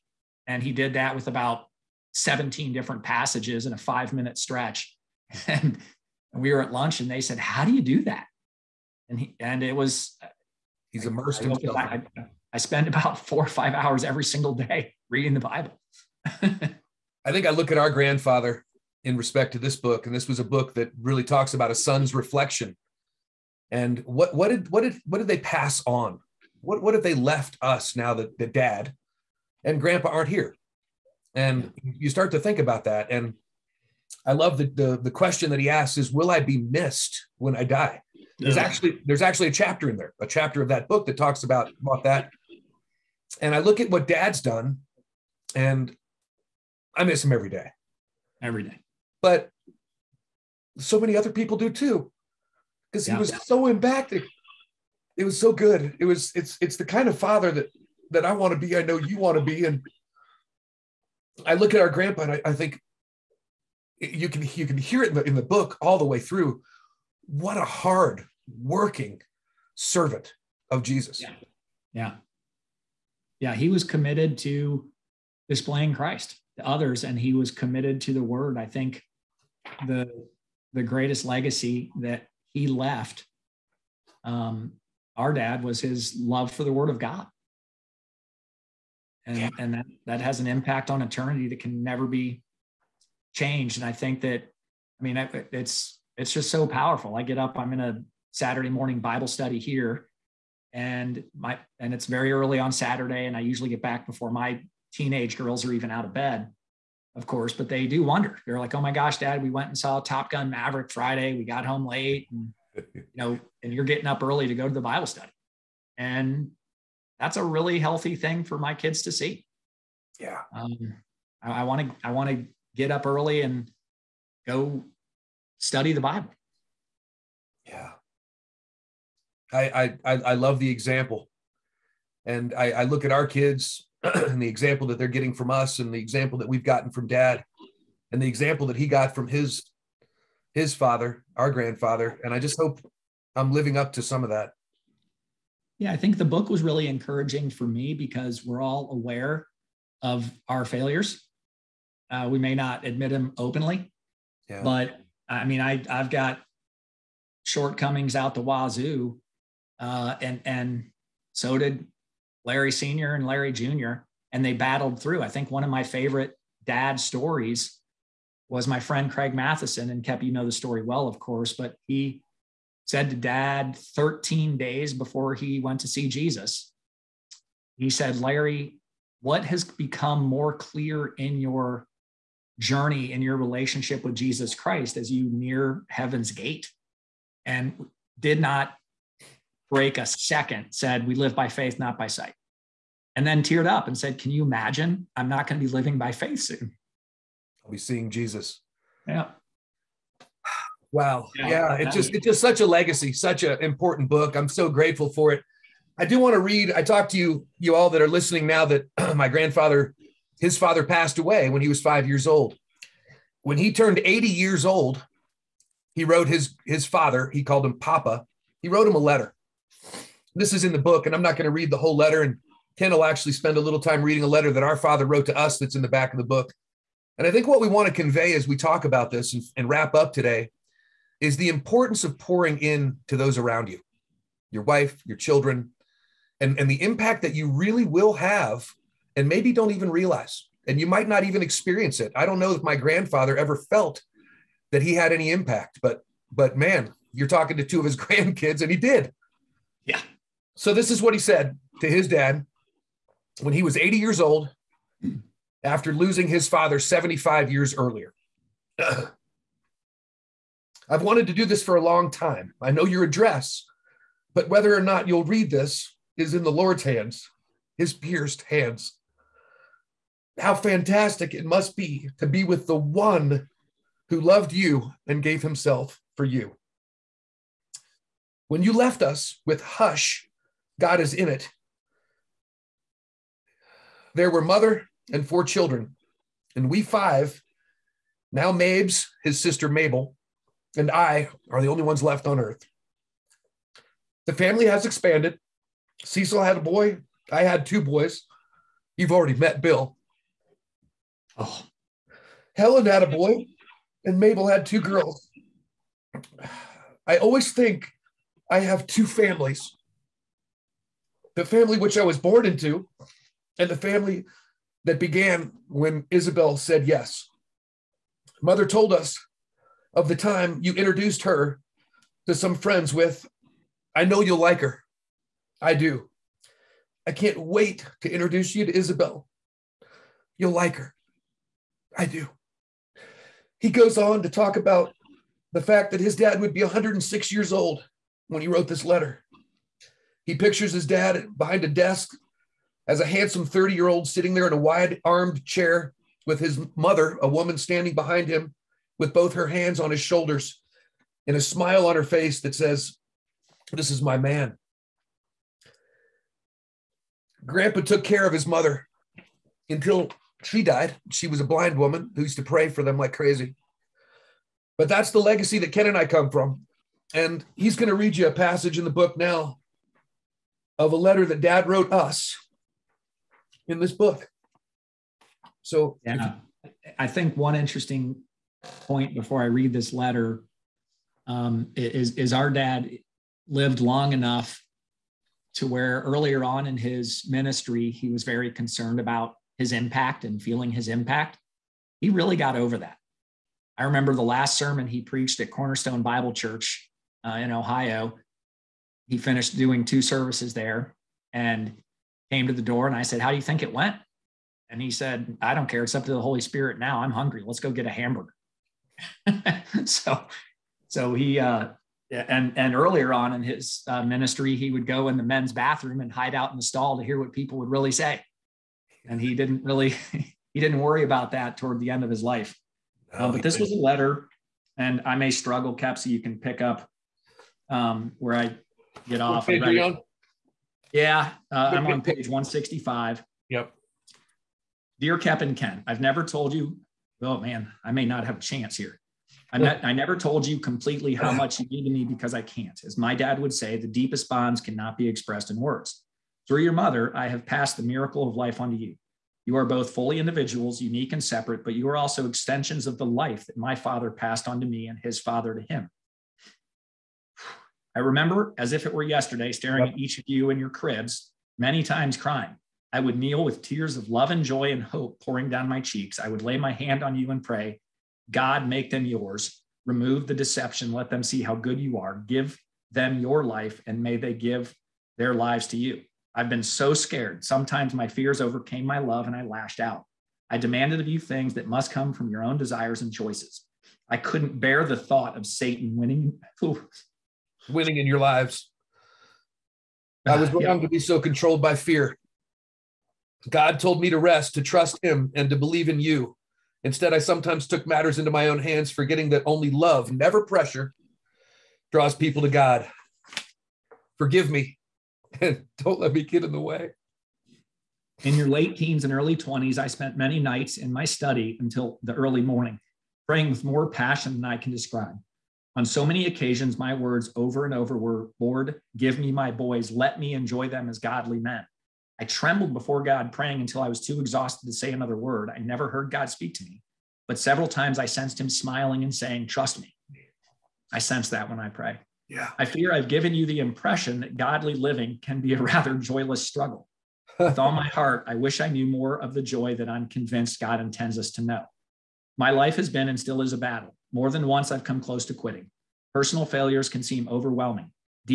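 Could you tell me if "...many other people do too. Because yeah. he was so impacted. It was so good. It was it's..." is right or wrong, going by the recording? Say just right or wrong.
right.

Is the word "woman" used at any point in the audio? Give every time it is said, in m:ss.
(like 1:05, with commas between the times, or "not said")
5:47, 6:01.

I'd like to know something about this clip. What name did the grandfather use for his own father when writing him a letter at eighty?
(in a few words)
Papa.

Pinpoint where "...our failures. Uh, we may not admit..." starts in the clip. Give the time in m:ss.
2:30.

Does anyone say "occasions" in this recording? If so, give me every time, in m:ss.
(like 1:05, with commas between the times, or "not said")
8:36.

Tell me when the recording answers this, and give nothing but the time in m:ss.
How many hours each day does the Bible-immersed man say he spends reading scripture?
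0:13.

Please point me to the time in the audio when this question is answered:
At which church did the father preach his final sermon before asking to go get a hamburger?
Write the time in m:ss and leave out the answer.
6:35.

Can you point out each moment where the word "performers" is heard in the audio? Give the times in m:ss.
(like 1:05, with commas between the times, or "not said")
not said.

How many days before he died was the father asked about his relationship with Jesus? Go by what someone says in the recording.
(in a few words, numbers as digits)
13.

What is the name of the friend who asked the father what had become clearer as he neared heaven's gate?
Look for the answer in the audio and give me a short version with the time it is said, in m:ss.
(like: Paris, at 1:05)
Craig Matheson, at 2:49.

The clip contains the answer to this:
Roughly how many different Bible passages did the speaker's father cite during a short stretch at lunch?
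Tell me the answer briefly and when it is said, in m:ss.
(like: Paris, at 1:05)
17, at 0:02.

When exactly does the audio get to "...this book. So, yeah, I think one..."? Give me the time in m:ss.
6:13.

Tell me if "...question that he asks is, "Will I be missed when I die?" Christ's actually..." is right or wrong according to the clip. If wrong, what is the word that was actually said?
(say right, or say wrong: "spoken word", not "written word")
wrong: "There", not "Christ".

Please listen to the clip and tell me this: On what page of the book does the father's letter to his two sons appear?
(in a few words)
165.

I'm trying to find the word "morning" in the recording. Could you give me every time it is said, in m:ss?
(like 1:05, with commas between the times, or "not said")
1:38, 8:32.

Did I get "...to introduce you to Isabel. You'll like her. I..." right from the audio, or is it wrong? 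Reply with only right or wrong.
right.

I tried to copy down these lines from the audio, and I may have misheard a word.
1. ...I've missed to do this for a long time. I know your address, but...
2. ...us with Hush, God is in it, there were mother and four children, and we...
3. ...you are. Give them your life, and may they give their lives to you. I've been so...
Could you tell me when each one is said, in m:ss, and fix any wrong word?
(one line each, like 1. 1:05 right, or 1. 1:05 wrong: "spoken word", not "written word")
1. 4:18 wrong: "wanted", not "missed"
2. 4:39 right
3. 7:51 right.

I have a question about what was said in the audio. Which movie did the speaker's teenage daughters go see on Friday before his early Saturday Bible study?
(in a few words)
Top Gun Maverick.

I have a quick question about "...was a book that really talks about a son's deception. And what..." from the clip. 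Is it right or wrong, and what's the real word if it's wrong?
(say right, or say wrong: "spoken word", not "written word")
wrong: "reflection", not "deception".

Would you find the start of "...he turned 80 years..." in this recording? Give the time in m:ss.
3:33.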